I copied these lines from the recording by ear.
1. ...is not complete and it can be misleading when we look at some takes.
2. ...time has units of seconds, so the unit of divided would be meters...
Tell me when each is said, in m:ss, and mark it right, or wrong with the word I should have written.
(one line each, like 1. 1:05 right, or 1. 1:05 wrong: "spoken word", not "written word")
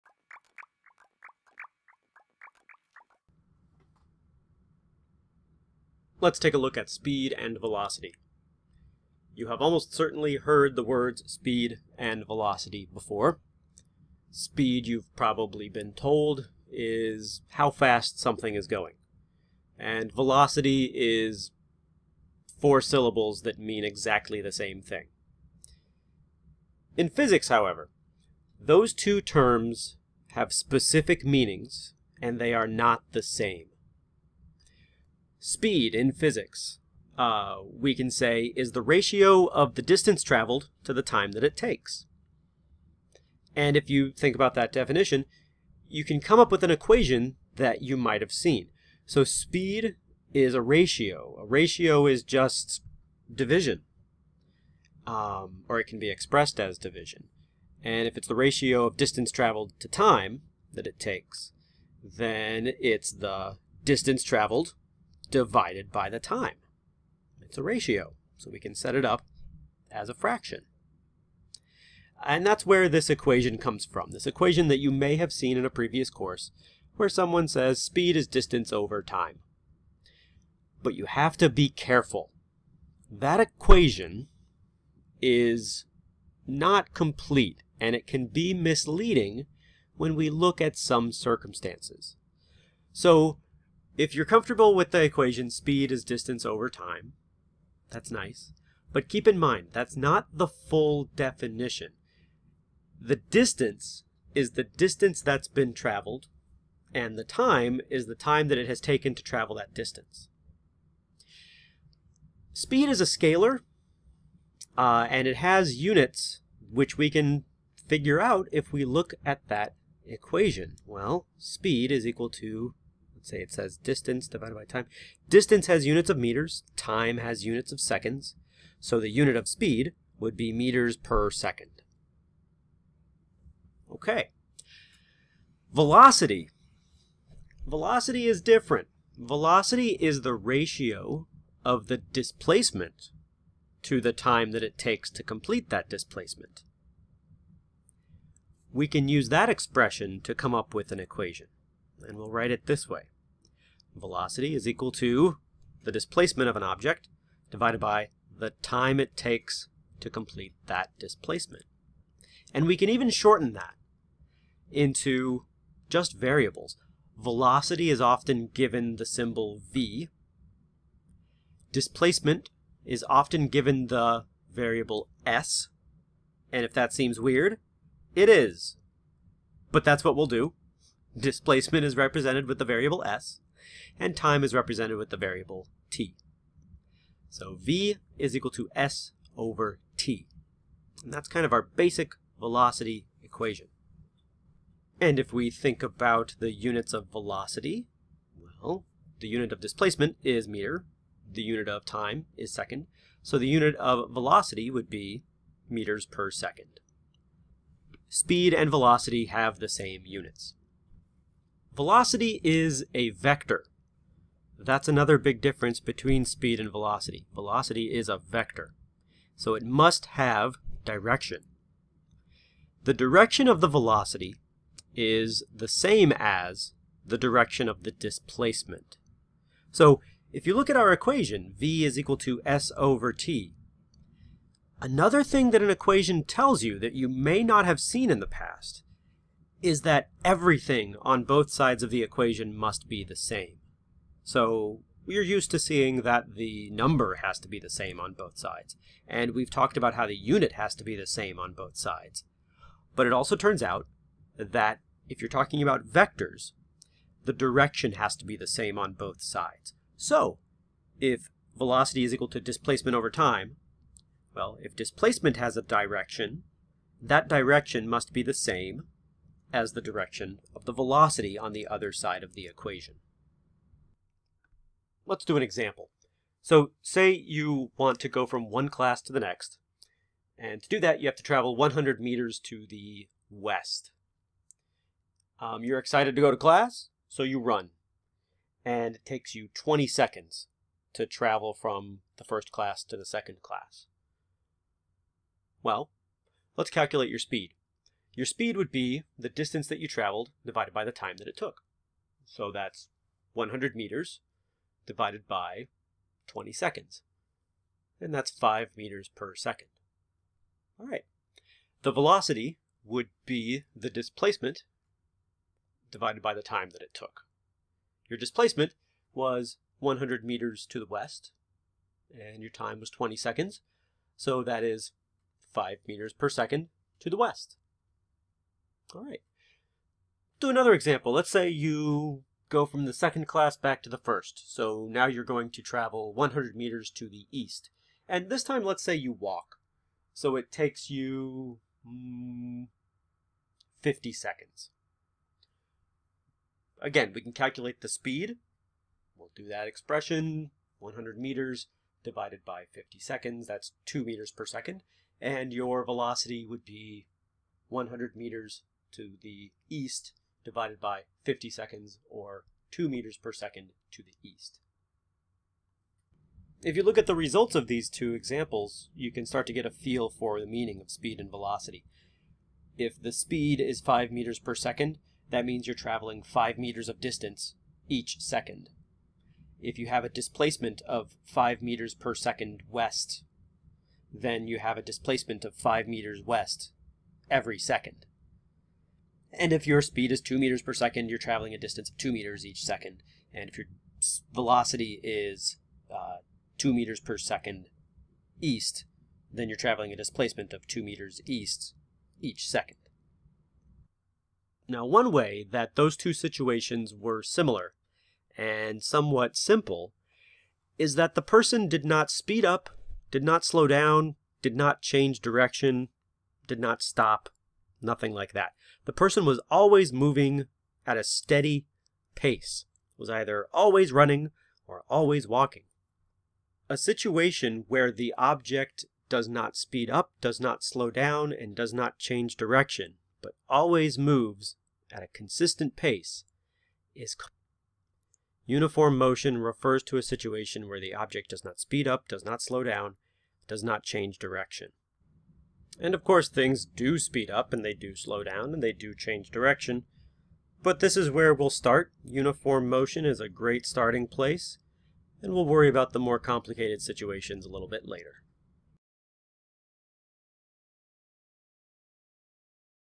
1. 1:25 wrong: "circumstances", not "takes"
2. 2:06 wrong: "speed", not "divided".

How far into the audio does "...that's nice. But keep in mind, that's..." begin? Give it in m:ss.
1:37.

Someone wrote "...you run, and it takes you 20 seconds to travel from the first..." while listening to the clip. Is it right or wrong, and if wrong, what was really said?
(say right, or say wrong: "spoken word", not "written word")
right.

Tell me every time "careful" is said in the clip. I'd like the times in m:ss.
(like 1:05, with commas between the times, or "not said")
1:21.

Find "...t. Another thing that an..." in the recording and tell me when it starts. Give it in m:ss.
3:53.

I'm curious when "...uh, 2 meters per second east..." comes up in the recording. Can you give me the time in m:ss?
6:35.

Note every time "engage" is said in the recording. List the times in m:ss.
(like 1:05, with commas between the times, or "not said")
not said.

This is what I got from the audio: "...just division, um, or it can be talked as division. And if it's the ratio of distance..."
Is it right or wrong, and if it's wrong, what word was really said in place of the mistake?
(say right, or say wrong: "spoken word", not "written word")
wrong: "expressed", not "talked".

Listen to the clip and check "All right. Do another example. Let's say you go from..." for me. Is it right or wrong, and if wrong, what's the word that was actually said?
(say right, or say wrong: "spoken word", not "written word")
right.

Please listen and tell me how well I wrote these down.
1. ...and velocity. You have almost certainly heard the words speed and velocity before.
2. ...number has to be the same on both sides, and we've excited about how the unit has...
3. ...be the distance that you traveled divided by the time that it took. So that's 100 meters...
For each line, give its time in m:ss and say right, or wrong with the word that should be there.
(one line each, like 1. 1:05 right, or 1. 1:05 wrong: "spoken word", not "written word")
1. 0:07 right
2. 4:06 wrong: "talked", not "excited"
3. 4:58 right.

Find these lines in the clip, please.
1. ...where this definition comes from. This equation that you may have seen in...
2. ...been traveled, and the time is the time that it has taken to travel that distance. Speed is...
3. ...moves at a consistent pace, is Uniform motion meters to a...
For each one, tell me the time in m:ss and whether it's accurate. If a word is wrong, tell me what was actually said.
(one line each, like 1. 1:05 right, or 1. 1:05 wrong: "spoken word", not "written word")
1. 1:12 wrong: "equation", not "definition"
2. 1:45 right
3. 7:13 wrong: "refers", not "meters".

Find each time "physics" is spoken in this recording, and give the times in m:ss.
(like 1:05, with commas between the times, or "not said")
0:27, 0:36.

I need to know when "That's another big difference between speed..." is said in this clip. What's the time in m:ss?
3:34.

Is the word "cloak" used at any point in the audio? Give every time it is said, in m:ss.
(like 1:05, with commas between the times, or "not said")
not said.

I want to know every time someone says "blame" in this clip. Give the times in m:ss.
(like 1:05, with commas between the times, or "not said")
not said.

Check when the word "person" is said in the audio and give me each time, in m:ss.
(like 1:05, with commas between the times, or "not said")
6:51, 6:59.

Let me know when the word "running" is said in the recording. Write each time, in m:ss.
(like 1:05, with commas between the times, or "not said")
7:03.